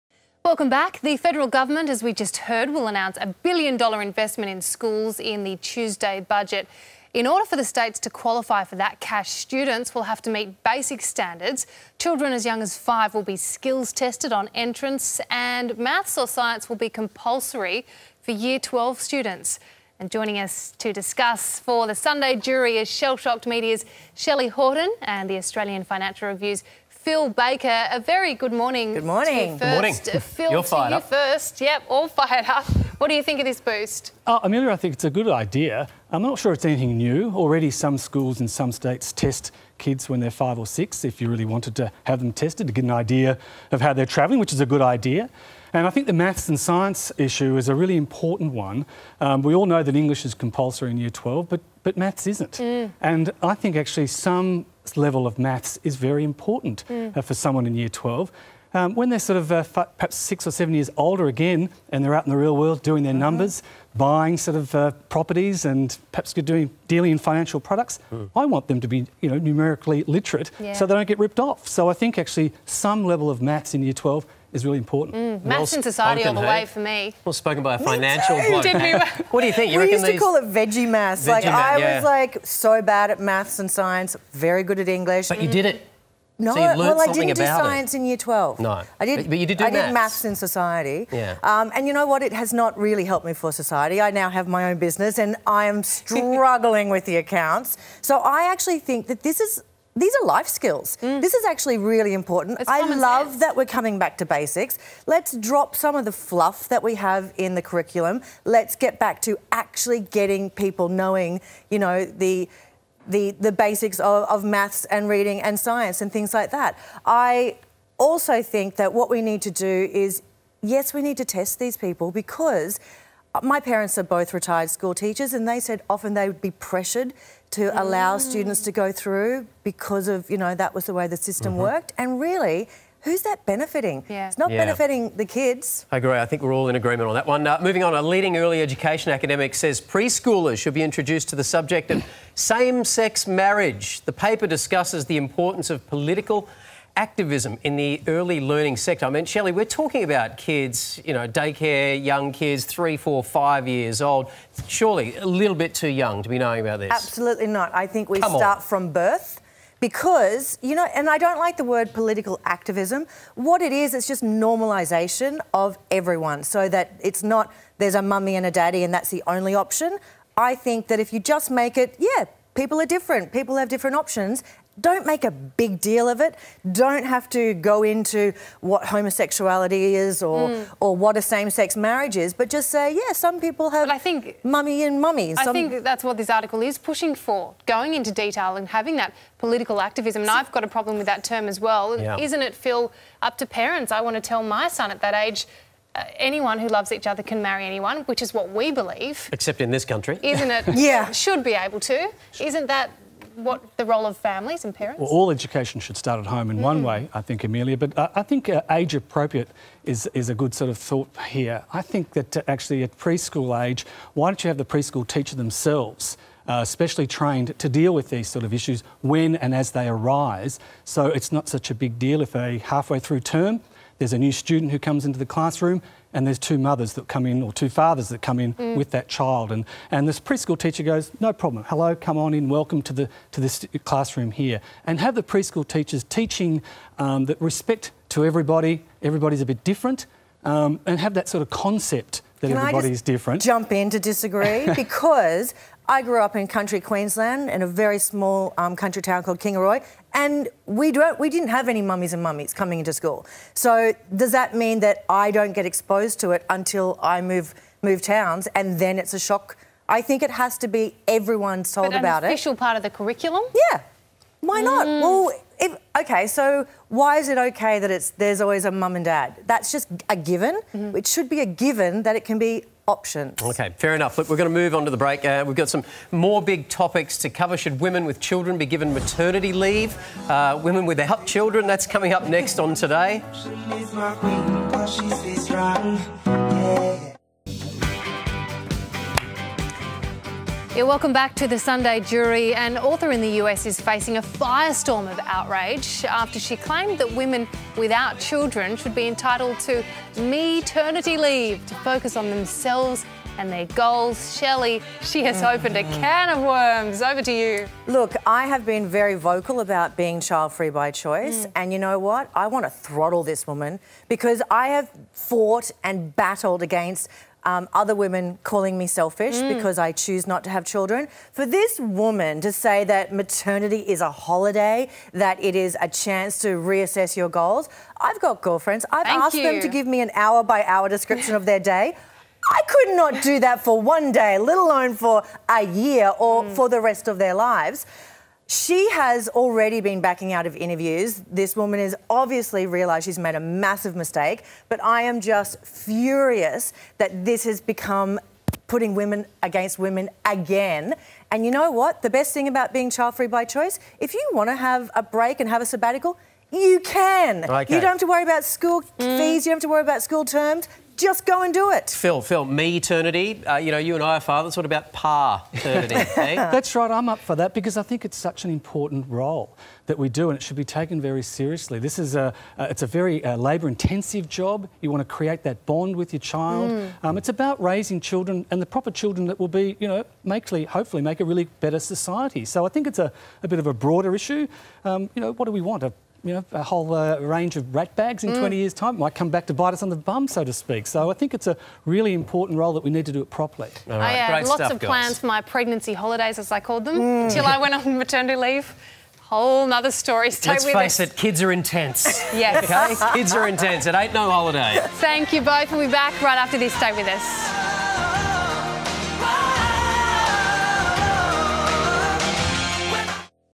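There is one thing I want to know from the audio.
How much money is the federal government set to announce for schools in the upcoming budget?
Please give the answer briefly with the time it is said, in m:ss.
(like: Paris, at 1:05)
$1 billion, at 0:03.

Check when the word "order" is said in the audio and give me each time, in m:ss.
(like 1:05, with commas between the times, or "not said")
0:07.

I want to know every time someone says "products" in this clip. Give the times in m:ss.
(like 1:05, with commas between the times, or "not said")
1:07.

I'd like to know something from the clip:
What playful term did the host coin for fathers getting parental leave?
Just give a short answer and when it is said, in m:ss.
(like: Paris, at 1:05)
par eternity, at 6:04.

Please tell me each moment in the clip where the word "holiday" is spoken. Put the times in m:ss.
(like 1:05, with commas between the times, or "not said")
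5:24, 6:35, 6:44.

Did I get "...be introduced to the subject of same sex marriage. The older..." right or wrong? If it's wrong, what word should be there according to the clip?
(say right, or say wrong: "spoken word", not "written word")
wrong: "paper", not "older".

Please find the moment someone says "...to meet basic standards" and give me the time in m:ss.
0:10.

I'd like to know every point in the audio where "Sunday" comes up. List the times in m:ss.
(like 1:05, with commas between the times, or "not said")
0:21, 4:51.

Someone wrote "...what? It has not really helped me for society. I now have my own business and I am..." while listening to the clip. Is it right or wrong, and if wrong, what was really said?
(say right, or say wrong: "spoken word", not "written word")
right.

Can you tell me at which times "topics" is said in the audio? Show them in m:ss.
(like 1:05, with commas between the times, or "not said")
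4:36.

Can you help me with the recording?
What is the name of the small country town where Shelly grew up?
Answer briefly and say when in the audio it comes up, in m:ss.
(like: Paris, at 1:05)
Kingaroy, at 4:09.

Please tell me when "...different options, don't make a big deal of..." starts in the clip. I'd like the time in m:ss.
2:53.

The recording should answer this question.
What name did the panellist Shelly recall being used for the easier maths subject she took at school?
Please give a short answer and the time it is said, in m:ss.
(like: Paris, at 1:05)
veggie maths, at 1:20.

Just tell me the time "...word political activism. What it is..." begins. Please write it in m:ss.
2:41.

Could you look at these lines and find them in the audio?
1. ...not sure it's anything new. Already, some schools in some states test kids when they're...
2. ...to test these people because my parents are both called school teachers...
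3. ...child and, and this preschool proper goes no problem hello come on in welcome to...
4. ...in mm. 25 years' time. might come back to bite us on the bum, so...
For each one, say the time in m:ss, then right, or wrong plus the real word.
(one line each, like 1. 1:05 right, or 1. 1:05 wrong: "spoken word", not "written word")
1. 0:36 right
2. 2:01 wrong: "retired", not "called"
3. 3:49 wrong: "teacher", not "proper"
4. 6:28 wrong: "20", not "25".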